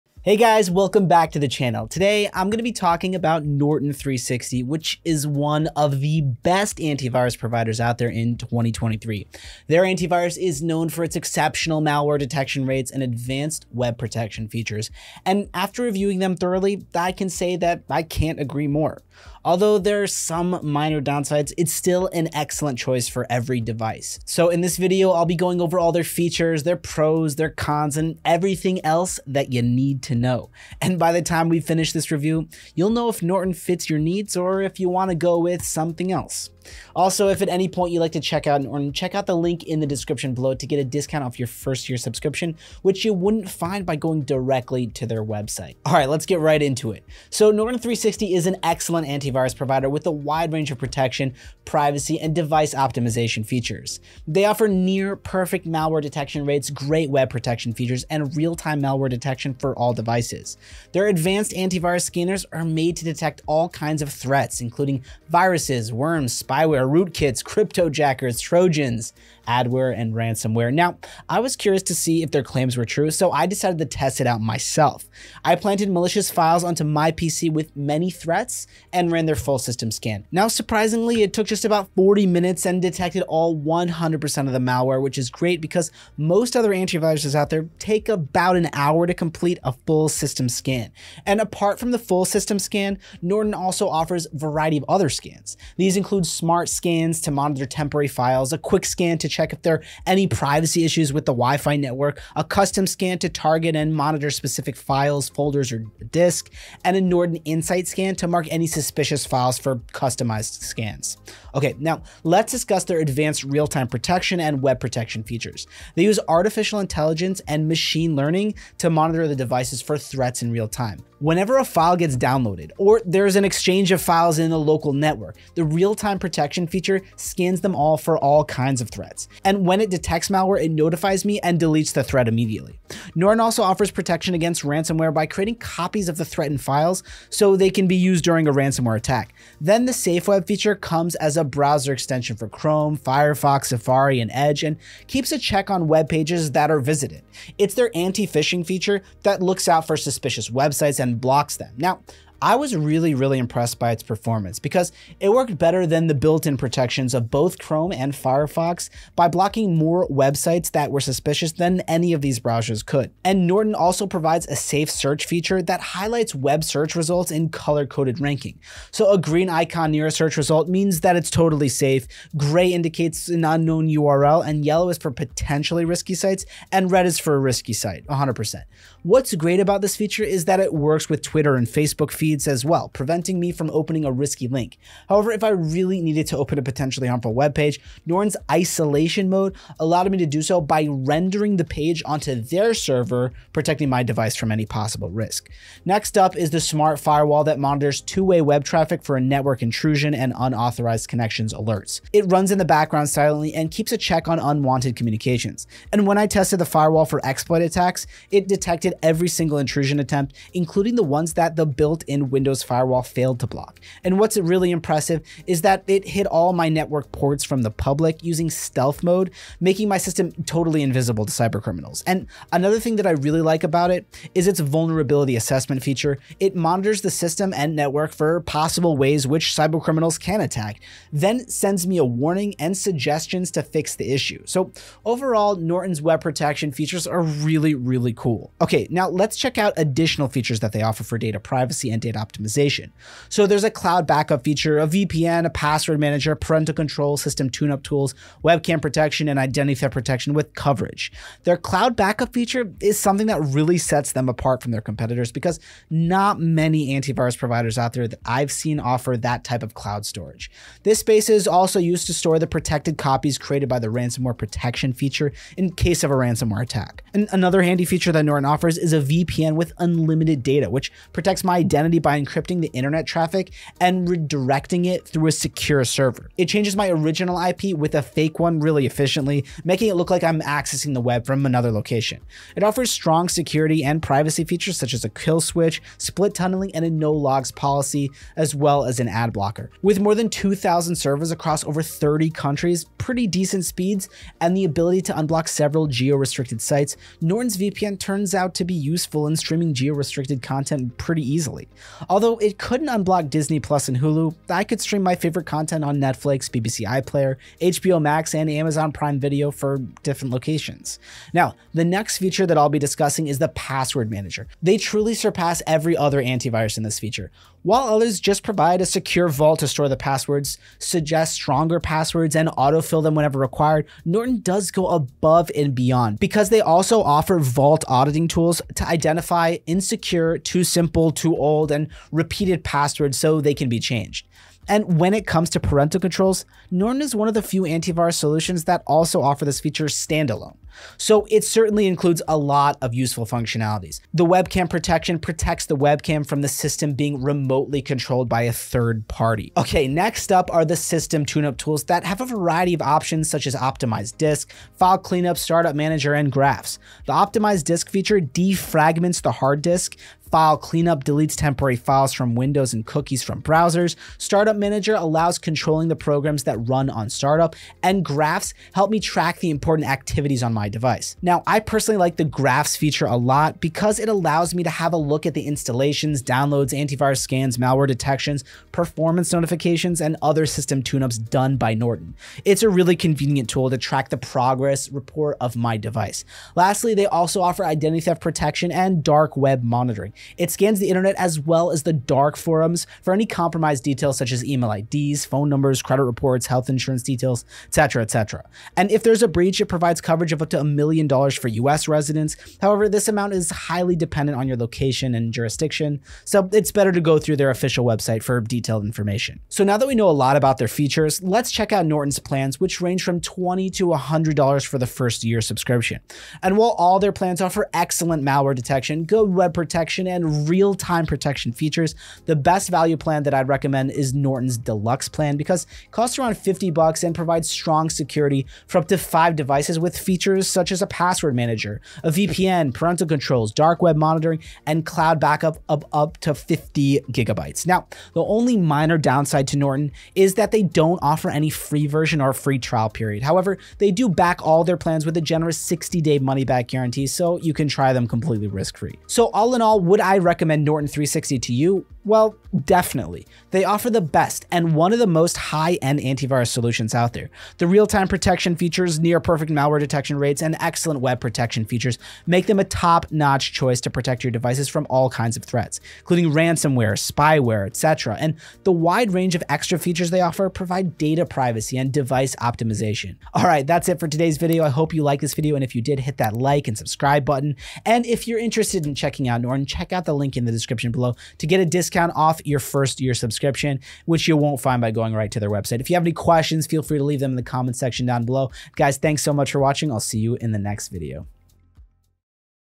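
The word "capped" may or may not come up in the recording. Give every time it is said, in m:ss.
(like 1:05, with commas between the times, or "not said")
not said.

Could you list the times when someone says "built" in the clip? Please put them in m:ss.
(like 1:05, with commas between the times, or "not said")
2:36, 3:31.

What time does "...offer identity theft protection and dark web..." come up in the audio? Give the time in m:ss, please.
6:27.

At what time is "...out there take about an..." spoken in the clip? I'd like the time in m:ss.
1:27.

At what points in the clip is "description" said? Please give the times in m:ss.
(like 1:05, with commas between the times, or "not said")
0:39, 8:00.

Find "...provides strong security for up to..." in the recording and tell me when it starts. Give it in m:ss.
7:07.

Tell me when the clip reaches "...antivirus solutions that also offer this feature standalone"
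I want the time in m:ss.
5:37.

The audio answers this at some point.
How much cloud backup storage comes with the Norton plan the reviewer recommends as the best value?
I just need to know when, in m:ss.
7:16.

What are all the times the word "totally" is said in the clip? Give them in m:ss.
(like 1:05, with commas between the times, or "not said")
2:51, 3:40.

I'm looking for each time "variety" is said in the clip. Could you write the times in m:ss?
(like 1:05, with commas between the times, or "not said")
1:34, 5:52.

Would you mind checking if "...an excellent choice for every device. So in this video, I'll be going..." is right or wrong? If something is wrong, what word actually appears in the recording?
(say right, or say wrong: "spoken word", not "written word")
right.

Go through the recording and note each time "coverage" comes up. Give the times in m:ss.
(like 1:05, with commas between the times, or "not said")
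4:10, 6:40.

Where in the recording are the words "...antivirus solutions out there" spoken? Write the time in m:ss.
7:35.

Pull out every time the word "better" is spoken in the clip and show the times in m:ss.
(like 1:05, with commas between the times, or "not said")
2:35, 6:46.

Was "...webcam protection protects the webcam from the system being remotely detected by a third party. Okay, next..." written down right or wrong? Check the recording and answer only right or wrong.
wrong.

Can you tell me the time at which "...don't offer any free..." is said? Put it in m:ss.
7:20.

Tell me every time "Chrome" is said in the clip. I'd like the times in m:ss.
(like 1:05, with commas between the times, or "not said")
2:22, 2:37.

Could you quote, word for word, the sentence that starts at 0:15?
And after reviewing them thoroughly, I can say that I can't agree more.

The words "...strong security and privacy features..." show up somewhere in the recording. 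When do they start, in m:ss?
4:42.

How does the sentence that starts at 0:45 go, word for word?
All right, let's get right into it.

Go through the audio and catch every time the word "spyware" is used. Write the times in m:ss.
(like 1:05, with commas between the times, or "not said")
1:06, 7:46.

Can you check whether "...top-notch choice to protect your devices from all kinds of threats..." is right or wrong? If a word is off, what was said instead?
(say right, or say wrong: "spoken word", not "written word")
right.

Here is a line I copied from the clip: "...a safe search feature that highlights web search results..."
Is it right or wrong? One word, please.
right.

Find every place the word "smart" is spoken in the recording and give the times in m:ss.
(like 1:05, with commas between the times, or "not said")
1:36, 3:16.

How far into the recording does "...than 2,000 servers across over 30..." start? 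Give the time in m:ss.
4:50.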